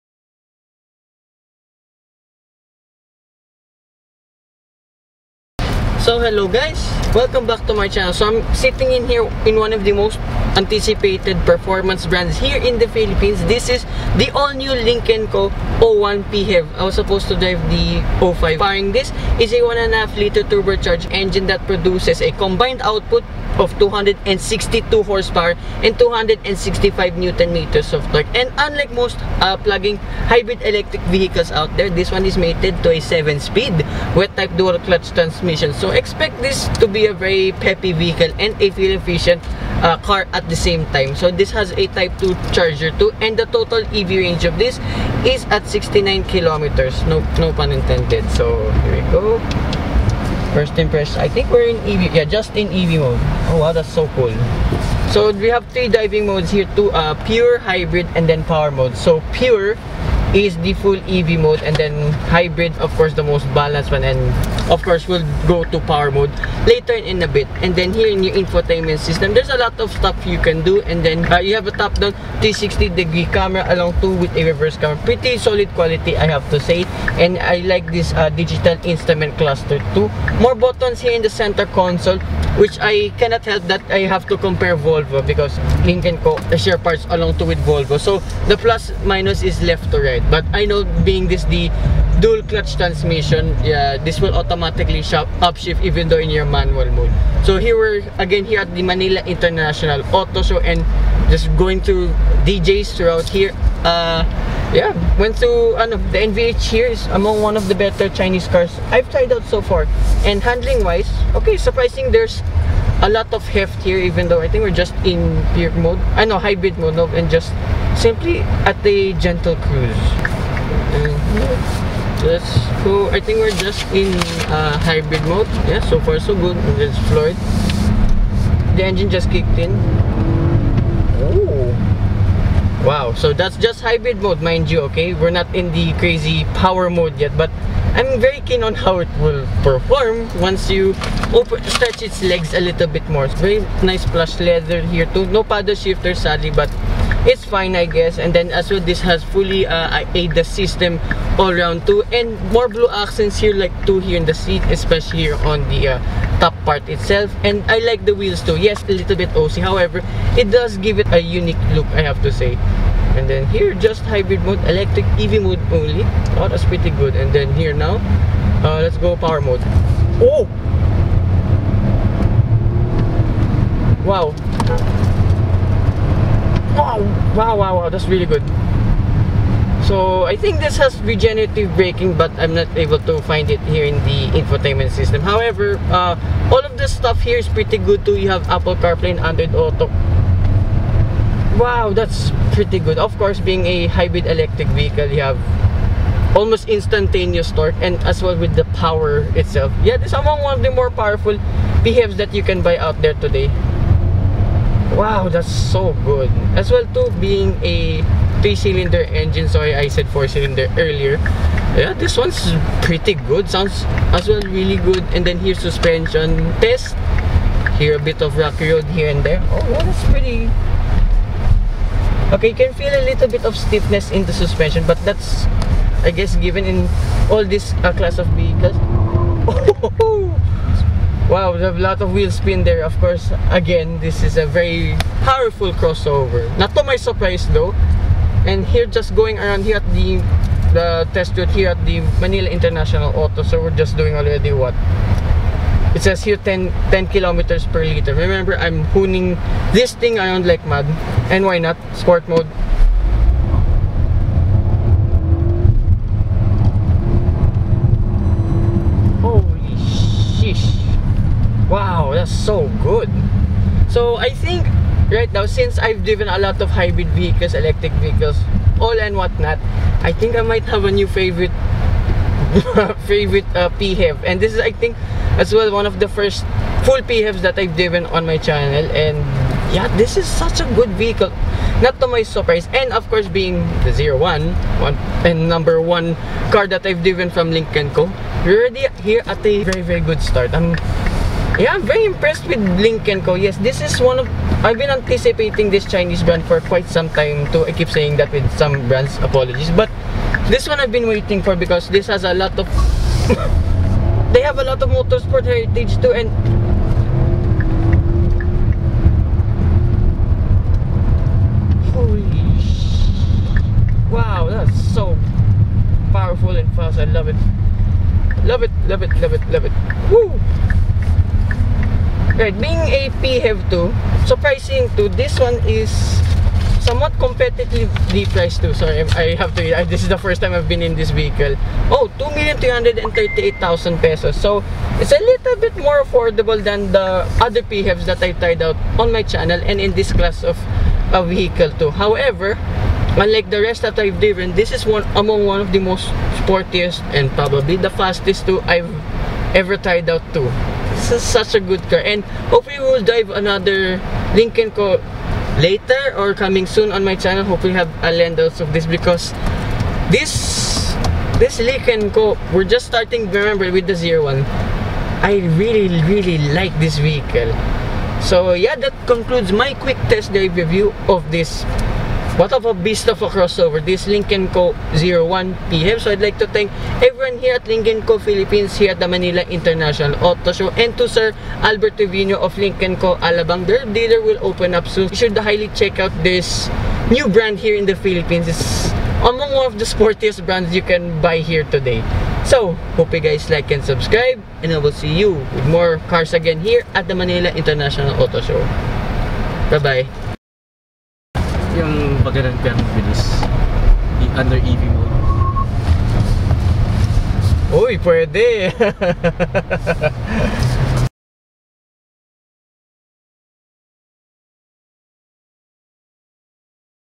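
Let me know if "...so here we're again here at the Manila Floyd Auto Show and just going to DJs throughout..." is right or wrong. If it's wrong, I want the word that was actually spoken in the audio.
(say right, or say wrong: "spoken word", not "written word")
wrong: "International", not "Floyd".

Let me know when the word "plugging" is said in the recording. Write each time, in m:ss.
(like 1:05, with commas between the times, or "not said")
0:29.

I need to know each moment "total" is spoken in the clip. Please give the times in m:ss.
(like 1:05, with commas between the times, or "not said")
0:43.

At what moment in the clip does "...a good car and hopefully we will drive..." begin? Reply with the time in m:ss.
5:51.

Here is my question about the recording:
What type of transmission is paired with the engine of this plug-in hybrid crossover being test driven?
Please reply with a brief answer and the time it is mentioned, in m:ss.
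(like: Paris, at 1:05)
7-speed wet-type dual clutch, at 0:32.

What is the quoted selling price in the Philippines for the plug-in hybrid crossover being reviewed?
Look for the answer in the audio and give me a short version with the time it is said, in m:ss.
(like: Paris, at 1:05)
2,338,000 pesos, at 5:32.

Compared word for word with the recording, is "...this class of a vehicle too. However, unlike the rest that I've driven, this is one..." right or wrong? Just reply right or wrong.
right.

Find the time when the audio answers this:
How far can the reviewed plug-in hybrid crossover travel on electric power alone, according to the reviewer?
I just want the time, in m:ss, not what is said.
0:45.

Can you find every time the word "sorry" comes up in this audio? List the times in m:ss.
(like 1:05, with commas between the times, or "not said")
3:29, 5:28.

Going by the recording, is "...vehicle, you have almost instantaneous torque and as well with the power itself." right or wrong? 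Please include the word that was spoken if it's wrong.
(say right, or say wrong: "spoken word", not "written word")
right.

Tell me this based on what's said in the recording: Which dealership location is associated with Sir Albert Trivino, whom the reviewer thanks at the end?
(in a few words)
Alabang.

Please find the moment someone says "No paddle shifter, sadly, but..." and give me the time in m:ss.
2:25.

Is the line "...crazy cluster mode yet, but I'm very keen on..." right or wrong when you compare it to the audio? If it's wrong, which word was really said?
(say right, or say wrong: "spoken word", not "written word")
wrong: "power", not "cluster".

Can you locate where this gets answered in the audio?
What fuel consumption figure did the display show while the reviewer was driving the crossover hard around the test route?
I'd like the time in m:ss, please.
4:06.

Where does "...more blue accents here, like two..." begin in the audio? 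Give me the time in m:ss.
2:32.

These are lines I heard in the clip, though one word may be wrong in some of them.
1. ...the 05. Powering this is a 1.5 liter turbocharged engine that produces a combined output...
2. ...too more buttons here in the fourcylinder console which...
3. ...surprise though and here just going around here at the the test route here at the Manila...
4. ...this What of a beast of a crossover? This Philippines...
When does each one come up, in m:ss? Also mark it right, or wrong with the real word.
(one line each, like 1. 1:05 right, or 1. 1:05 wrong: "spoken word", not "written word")
1. 0:17 right
2. 1:19 wrong: "center", not "fourcylinder"
3. 3:56 right
4. 6:11 wrong: "Lynk", not "Philippines".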